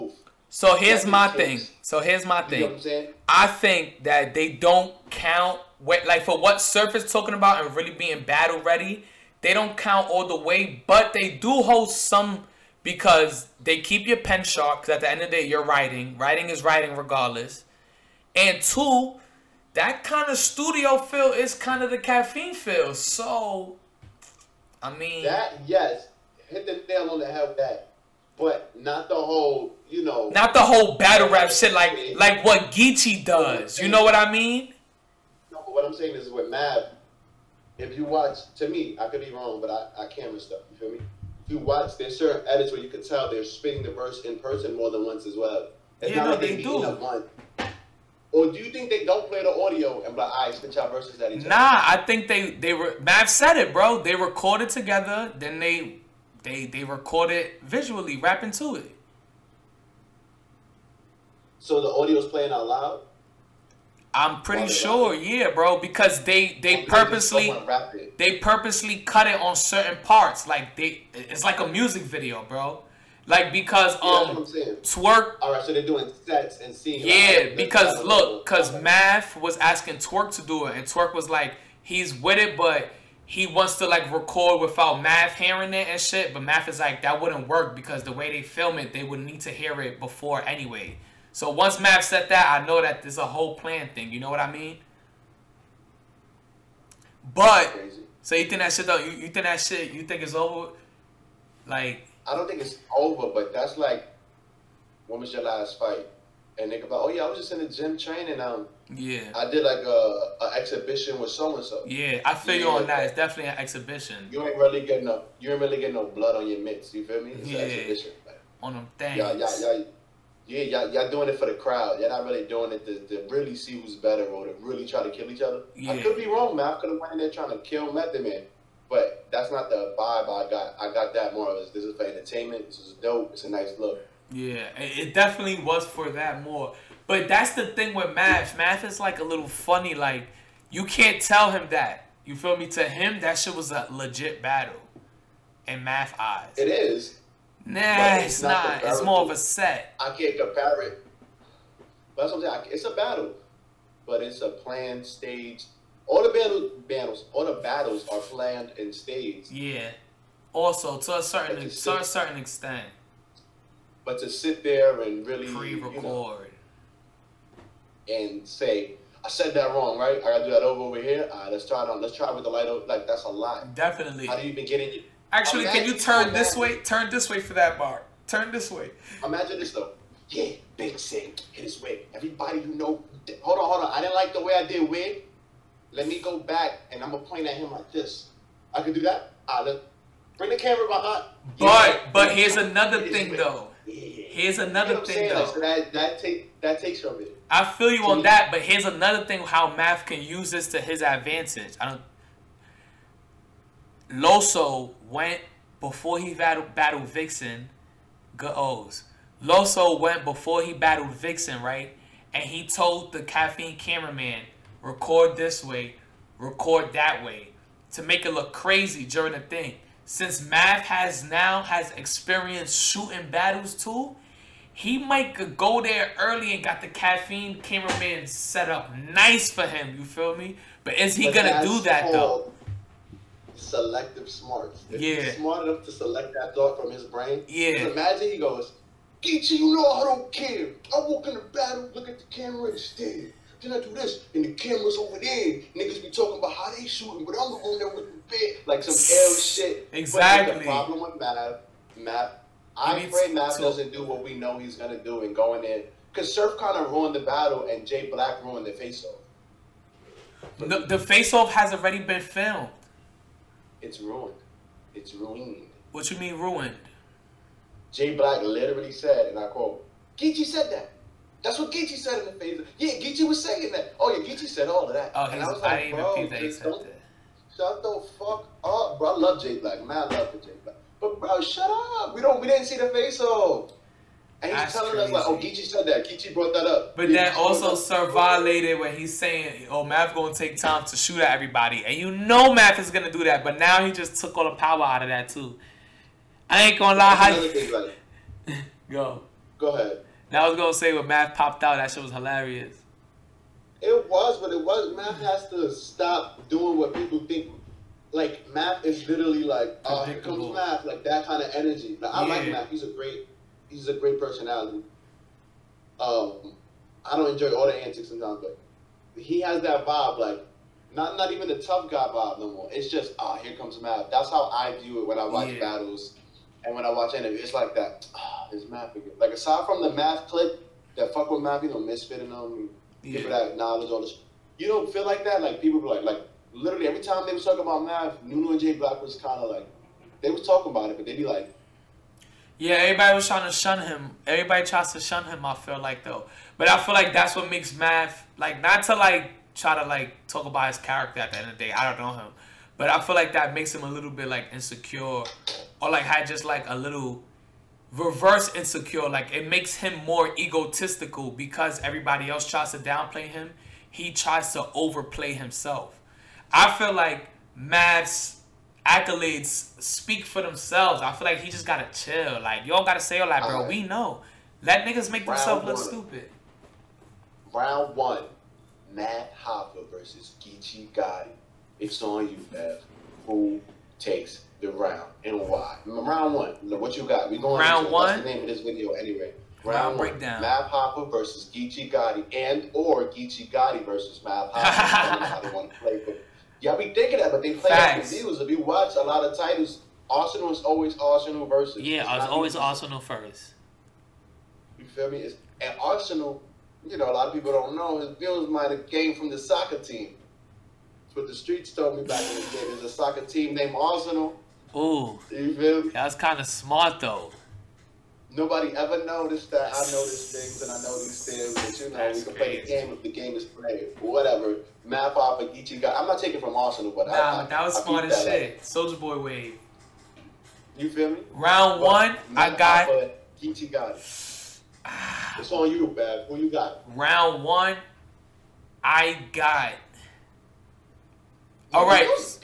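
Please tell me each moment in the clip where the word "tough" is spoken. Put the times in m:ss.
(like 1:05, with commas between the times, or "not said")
5:21.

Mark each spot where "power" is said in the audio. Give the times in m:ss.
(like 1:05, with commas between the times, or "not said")
4:54.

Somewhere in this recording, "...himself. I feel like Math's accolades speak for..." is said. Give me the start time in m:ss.
6:05.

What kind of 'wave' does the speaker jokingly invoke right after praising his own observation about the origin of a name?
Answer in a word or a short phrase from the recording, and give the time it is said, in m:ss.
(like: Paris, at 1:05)
Soldier Boy wave, at 7:08.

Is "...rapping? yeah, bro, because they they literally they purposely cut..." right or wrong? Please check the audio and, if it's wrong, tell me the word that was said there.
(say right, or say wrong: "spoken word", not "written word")
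wrong: "purposely", not "literally".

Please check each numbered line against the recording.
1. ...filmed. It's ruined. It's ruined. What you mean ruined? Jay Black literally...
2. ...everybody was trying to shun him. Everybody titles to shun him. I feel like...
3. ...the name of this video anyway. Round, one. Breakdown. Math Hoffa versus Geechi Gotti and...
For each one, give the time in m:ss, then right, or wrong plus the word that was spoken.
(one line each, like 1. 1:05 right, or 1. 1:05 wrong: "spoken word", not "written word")
1. 4:22 right
2. 5:42 wrong: "tries", not "titles"
3. 6:28 right.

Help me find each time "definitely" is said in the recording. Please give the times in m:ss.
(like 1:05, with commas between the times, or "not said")
1:53, 2:15, 2:53.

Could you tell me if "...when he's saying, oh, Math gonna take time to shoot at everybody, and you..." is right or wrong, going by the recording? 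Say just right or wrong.
right.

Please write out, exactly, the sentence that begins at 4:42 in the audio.
We don't, we didn't see the face off.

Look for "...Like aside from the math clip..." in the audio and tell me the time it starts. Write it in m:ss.
5:29.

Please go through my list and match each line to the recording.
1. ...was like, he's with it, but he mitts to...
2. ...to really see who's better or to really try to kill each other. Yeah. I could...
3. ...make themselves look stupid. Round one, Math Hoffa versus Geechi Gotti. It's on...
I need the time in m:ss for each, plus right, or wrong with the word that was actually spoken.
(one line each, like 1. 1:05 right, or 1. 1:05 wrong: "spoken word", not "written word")
1. 1:21 wrong: "wants", not "mitts"
2. 2:03 right
3. 6:15 right.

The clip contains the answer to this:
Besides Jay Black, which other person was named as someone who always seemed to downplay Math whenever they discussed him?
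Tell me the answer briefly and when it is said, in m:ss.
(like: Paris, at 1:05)
Nuno, at 5:38.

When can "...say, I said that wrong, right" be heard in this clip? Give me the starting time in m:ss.
2:48.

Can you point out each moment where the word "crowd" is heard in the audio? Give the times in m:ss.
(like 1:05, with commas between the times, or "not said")
2:01.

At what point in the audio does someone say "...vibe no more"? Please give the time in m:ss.
5:22.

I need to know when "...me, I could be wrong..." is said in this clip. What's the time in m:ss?
0:38.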